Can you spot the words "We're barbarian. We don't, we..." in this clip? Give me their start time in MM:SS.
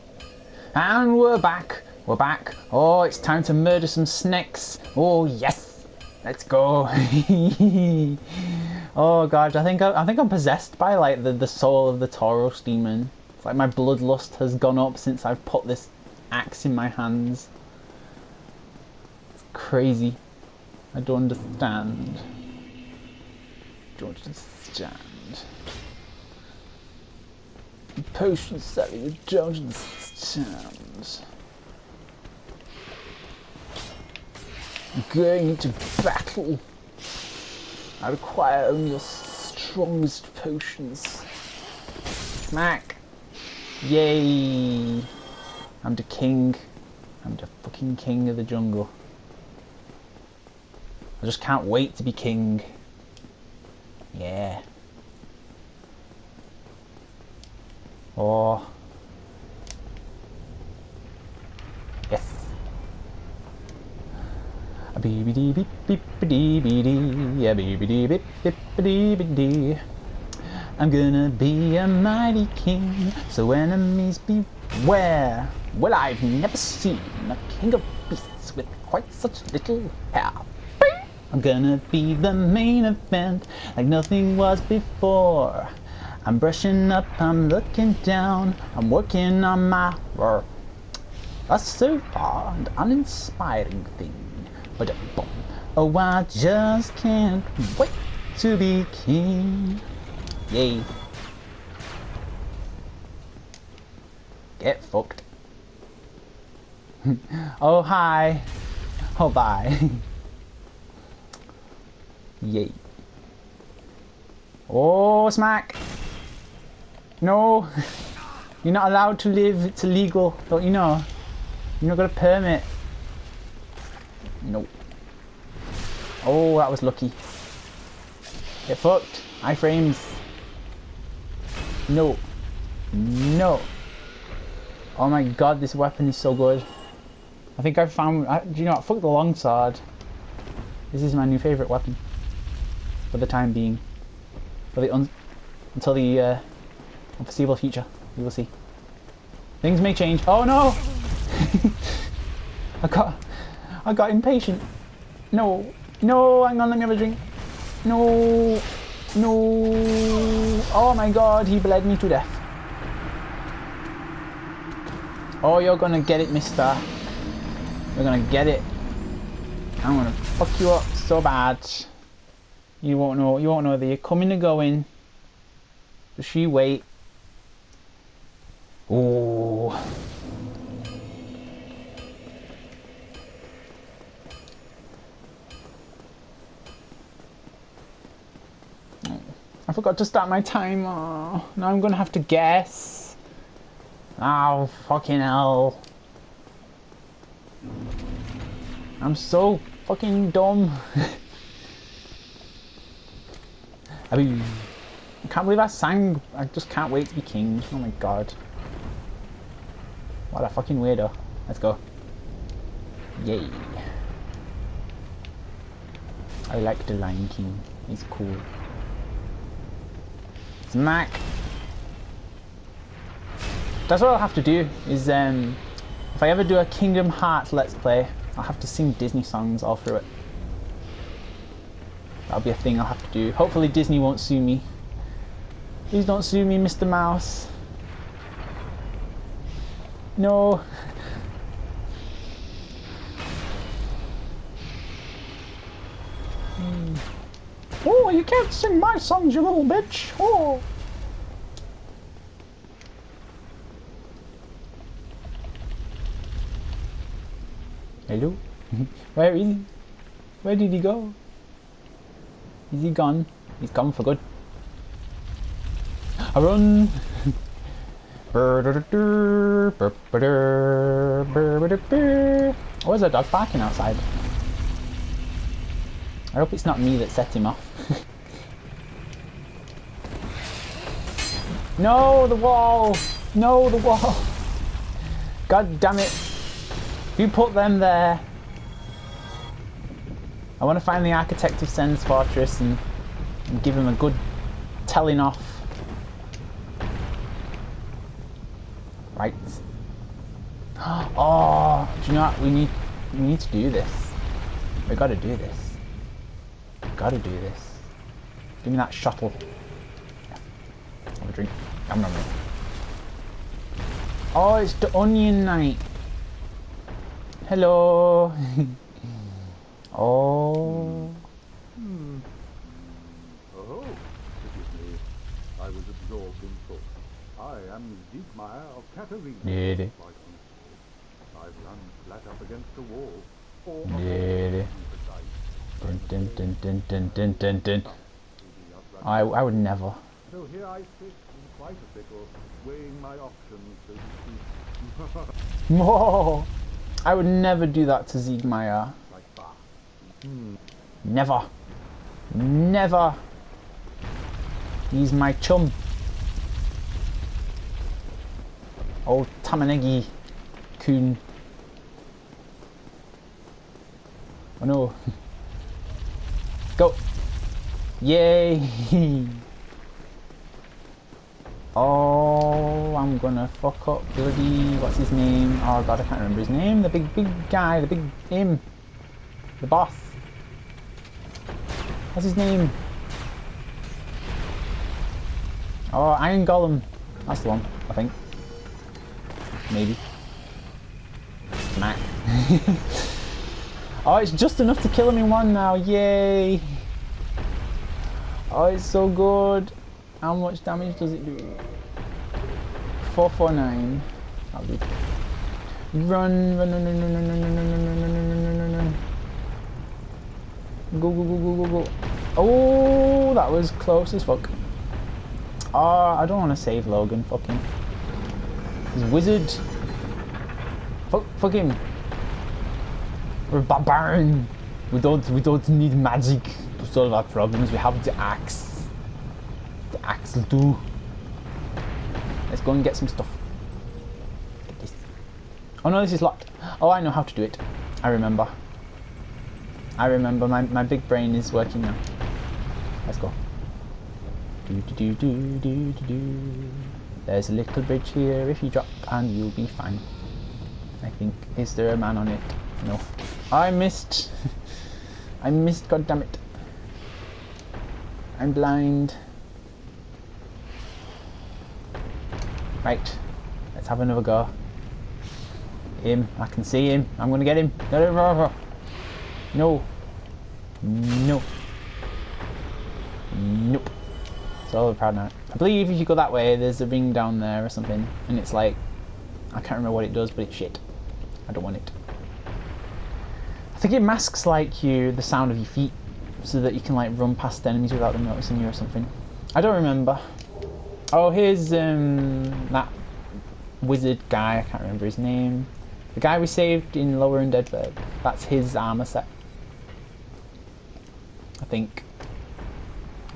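07:03.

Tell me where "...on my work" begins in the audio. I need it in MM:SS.
01:29.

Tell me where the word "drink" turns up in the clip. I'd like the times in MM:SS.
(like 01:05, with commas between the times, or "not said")
02:36, 05:11.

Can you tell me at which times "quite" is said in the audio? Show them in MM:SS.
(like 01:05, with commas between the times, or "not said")
01:18, 05:41.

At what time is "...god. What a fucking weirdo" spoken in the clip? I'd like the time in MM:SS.
03:27.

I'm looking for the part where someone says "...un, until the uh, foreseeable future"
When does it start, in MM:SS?
02:24.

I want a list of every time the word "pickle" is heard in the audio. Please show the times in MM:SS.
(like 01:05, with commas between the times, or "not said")
05:41.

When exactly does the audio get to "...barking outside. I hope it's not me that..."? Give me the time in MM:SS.
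04:33.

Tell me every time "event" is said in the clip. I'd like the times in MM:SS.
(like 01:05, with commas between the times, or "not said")
01:22.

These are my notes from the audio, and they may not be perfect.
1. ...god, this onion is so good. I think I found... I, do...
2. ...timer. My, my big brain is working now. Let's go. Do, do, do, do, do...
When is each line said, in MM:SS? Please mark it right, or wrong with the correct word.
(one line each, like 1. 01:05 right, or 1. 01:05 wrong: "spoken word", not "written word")
1. 02:15 wrong: "weapon", not "onion"
2. 07:20 wrong: "remember", not "timer".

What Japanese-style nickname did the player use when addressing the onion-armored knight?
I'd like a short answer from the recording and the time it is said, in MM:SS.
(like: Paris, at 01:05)
Tamanegi kun, at 05:59.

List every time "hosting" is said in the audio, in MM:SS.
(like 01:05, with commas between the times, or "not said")
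not said.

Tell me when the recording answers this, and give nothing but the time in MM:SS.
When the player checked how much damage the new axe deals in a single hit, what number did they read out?
06:43.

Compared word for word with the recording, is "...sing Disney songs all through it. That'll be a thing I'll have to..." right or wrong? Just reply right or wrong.
right.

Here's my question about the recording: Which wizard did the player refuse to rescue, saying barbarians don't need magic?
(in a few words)
Logan.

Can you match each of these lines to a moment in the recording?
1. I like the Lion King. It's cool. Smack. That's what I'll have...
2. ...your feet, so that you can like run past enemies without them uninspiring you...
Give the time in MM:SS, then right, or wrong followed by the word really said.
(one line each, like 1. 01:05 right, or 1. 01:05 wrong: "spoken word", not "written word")
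1. 03:36 right
2. 08:05 wrong: "noticing", not "uninspiring".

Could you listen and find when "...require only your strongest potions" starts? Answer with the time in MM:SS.
00:38.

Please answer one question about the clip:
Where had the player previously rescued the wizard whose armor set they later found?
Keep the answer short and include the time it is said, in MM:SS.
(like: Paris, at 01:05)
Lower Undead Burg, at 08:17.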